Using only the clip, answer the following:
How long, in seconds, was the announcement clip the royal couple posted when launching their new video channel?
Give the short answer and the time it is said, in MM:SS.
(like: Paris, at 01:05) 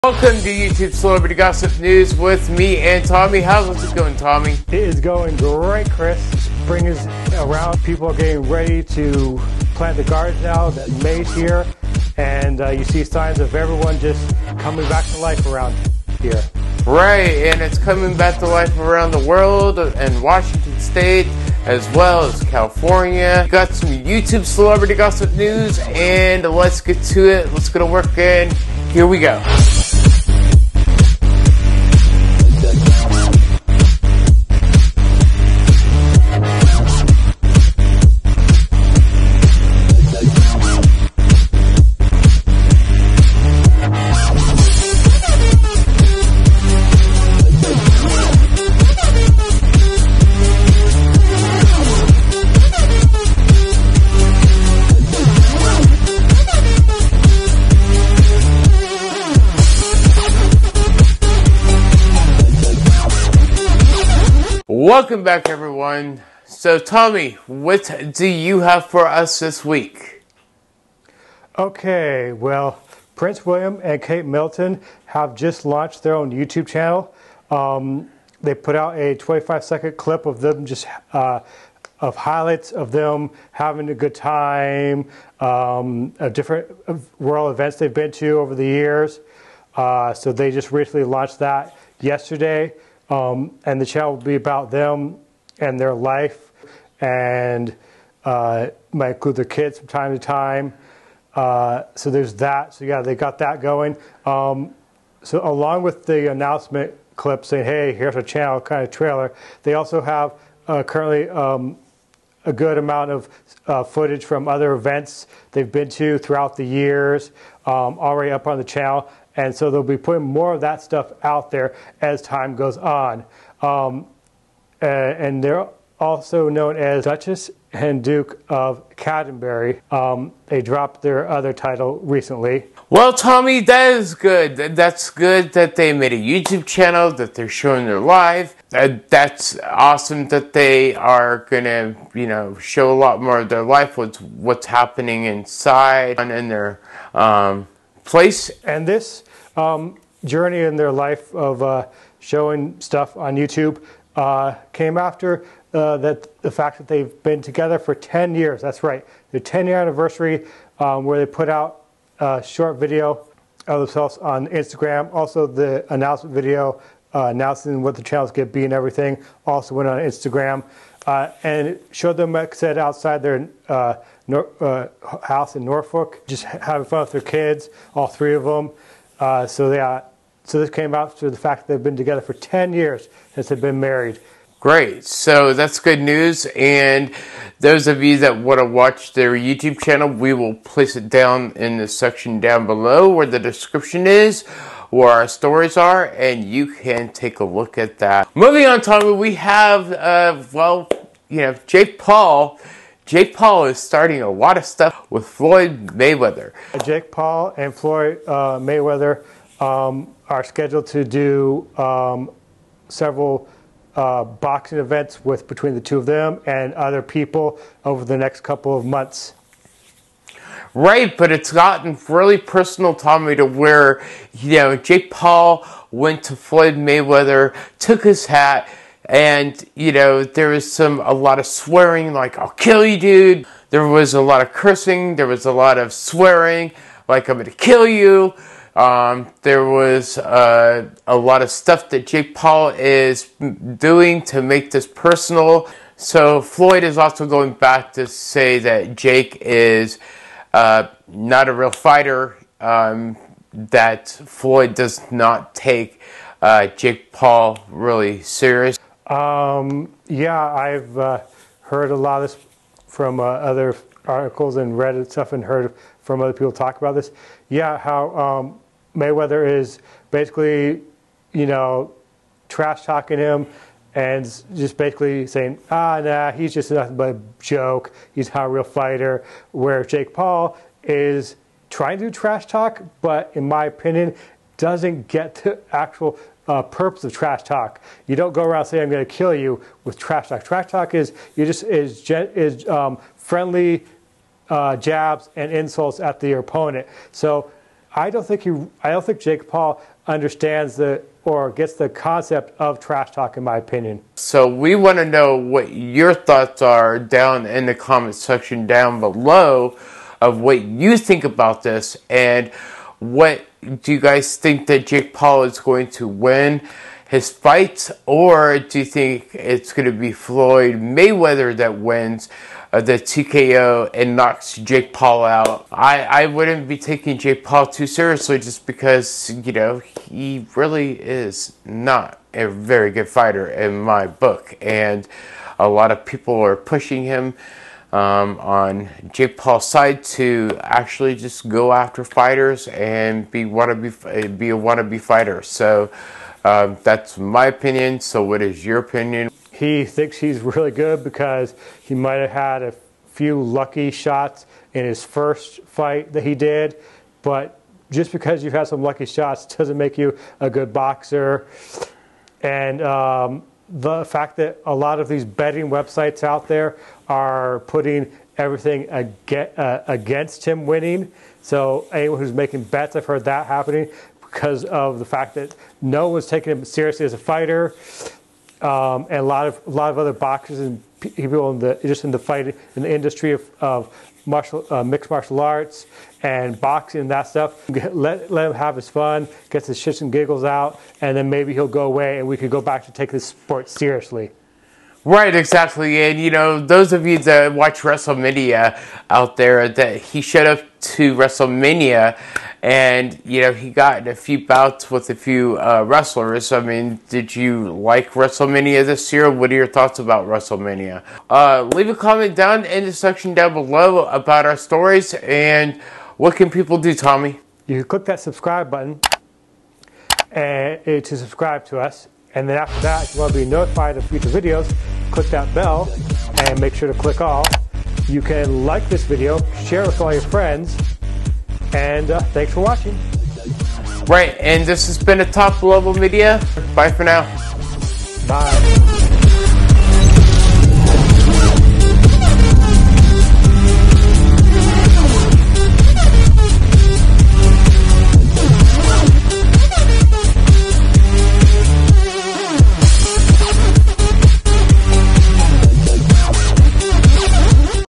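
25 seconds, at 01:19.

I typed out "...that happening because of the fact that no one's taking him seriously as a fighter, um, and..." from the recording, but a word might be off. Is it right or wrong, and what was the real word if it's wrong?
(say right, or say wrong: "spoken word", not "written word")
right.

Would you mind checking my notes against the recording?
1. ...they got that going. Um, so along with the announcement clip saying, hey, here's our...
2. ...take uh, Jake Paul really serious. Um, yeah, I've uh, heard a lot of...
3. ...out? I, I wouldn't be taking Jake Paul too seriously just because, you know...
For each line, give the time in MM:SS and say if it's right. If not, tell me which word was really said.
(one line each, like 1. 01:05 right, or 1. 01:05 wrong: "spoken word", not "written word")
1. 01:43 right
2. 04:15 right
3. 05:25 right.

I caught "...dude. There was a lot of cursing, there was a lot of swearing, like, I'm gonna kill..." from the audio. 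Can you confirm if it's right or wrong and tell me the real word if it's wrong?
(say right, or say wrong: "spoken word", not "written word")
right.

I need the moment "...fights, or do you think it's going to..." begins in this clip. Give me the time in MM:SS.
05:17.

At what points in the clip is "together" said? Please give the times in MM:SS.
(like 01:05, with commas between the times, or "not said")
02:37, 03:01.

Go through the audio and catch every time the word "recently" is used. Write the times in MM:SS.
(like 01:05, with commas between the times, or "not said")
01:30, 02:11.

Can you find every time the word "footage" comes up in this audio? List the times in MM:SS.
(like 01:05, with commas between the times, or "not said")
01:53.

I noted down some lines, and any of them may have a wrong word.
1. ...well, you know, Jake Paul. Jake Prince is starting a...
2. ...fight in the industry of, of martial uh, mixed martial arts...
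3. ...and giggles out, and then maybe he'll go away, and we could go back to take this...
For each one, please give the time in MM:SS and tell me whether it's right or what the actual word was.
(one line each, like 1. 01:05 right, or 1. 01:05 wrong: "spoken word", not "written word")
1. 03:20 wrong: "Paul", not "Prince"
2. 06:22 right
3. 06:30 right.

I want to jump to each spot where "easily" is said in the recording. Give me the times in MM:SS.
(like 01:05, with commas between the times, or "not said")
not said.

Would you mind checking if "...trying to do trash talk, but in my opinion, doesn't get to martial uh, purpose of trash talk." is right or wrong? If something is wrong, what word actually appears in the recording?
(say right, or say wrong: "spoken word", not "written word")
wrong: "actual", not "martial".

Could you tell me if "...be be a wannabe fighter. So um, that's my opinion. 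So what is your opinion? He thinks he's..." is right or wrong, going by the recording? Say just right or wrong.
right.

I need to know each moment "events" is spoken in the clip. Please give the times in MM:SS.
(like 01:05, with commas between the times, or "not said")
01:27, 01:54, 03:34.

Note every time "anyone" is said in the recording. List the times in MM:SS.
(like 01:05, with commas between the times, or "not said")
06:11.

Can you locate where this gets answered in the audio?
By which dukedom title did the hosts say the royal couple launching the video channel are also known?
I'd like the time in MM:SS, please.
02:08.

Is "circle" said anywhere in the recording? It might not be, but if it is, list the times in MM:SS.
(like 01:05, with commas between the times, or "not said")
not said.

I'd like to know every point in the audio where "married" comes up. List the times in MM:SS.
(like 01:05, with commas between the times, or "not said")
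03:03.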